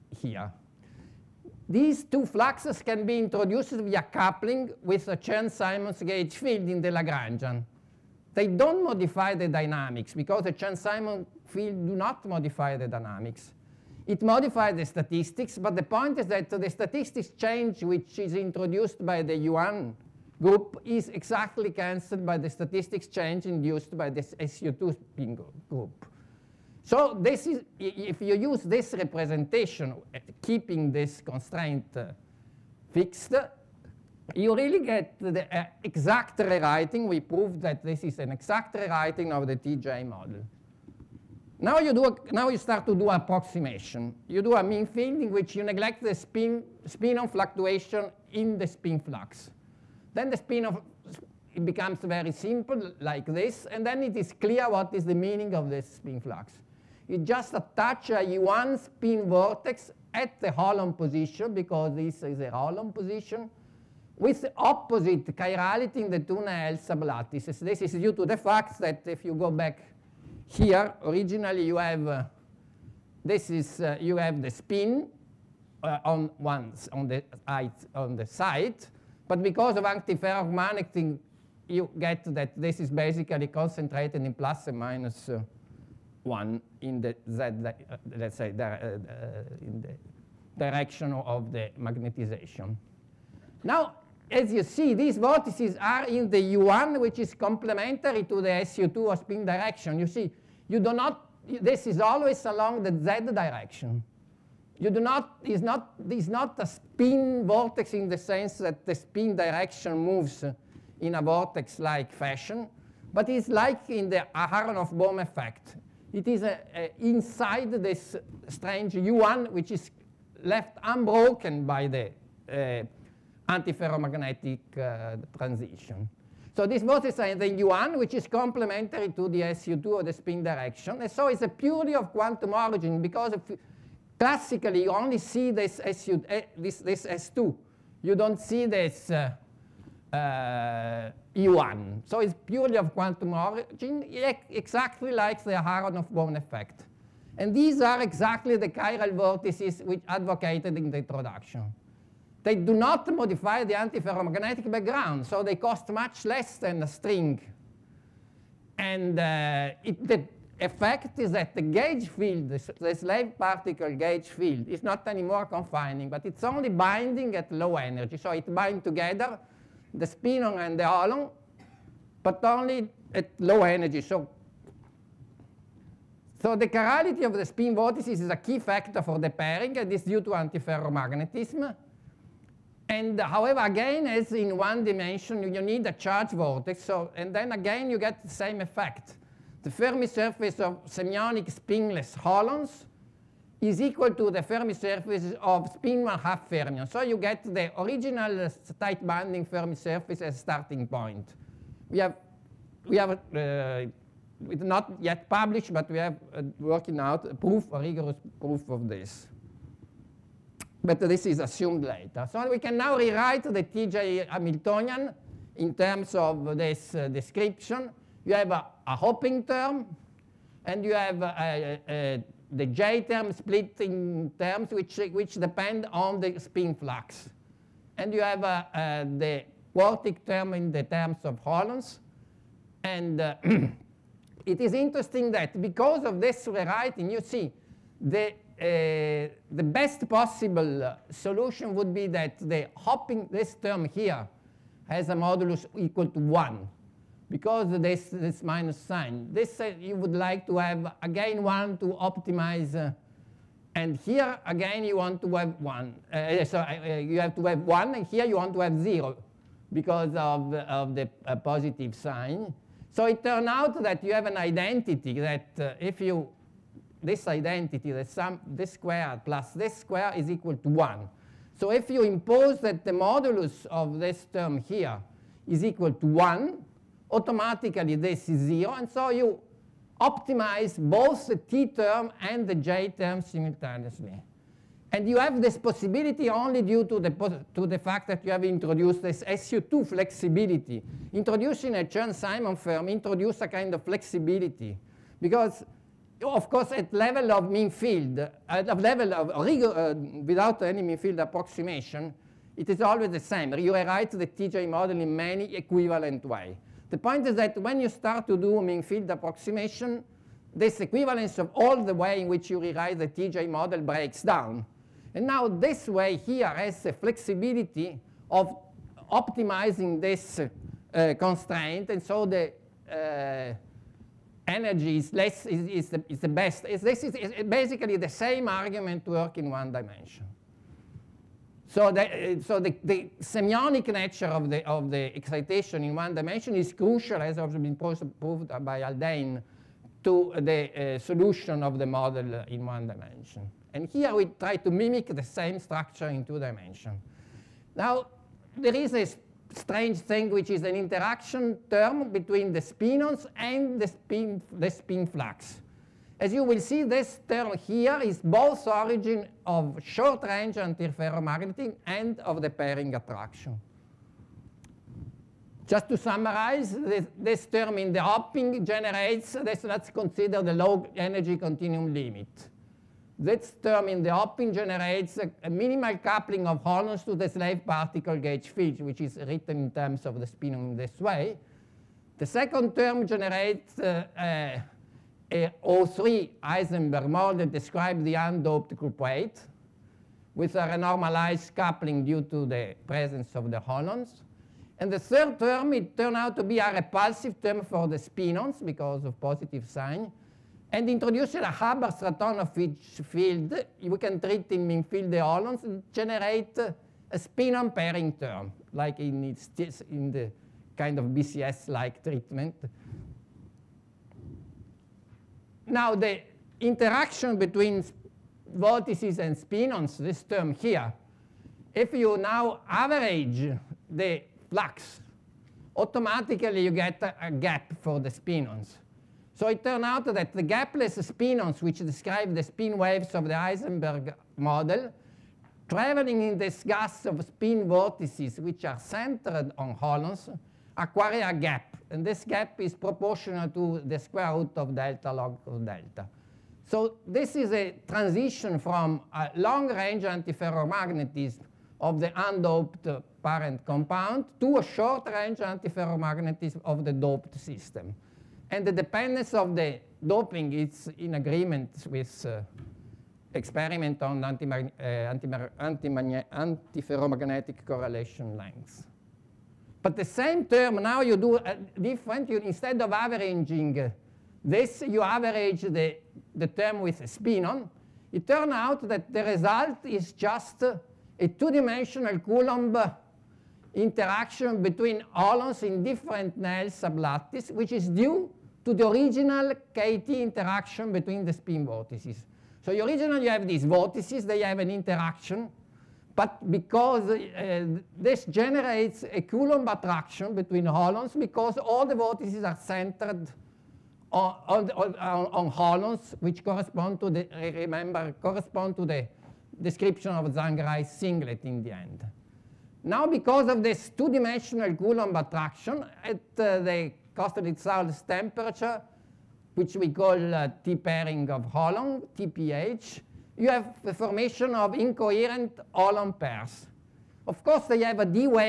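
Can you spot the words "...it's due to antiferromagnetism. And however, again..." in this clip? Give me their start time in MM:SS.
02:59.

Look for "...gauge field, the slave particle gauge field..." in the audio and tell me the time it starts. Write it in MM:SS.
02:41.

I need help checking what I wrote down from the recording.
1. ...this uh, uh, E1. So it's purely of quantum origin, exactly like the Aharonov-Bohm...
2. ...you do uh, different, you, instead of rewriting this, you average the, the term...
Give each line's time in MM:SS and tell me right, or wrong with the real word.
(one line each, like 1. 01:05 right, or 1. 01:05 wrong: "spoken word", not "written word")
1. 02:18 right
2. 07:51 wrong: "averaging", not "rewriting".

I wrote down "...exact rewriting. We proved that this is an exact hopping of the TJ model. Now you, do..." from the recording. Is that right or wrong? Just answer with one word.
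wrong.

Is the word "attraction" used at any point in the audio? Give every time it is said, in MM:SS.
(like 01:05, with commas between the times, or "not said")
06:02, 08:19, 08:35.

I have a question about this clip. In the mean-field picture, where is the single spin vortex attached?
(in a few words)
At the holon position.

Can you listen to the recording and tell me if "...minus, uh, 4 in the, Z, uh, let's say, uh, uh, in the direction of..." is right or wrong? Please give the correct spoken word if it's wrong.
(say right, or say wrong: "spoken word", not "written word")
wrong: "1", not "4".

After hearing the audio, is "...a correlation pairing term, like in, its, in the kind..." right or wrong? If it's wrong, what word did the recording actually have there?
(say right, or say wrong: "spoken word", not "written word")
wrong: "spinon", not "correlation".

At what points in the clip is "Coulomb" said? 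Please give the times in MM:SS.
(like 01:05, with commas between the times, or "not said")
08:02, 08:19, 08:34.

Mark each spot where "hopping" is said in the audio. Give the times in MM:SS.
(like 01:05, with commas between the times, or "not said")
03:38, 04:02, 06:08, 06:14.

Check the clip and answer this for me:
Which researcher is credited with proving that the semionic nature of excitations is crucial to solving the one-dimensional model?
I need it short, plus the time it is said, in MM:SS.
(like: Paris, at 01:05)
Haldane, at 05:38.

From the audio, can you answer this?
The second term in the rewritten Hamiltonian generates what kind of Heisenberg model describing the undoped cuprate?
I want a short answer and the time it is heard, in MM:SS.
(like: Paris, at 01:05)
O3 Heisenberg model, at 06:25.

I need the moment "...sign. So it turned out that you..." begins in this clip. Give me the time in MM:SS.
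04:21.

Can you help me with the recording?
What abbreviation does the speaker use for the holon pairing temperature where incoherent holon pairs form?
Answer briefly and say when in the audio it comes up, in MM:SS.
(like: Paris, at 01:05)
TPH, at 08:42.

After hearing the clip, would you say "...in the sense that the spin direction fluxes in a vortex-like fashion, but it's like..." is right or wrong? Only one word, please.
wrong.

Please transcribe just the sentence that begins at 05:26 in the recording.
Is, this is, is basically the same argument work in one dimension.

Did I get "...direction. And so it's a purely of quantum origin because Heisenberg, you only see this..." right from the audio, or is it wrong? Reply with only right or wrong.
wrong.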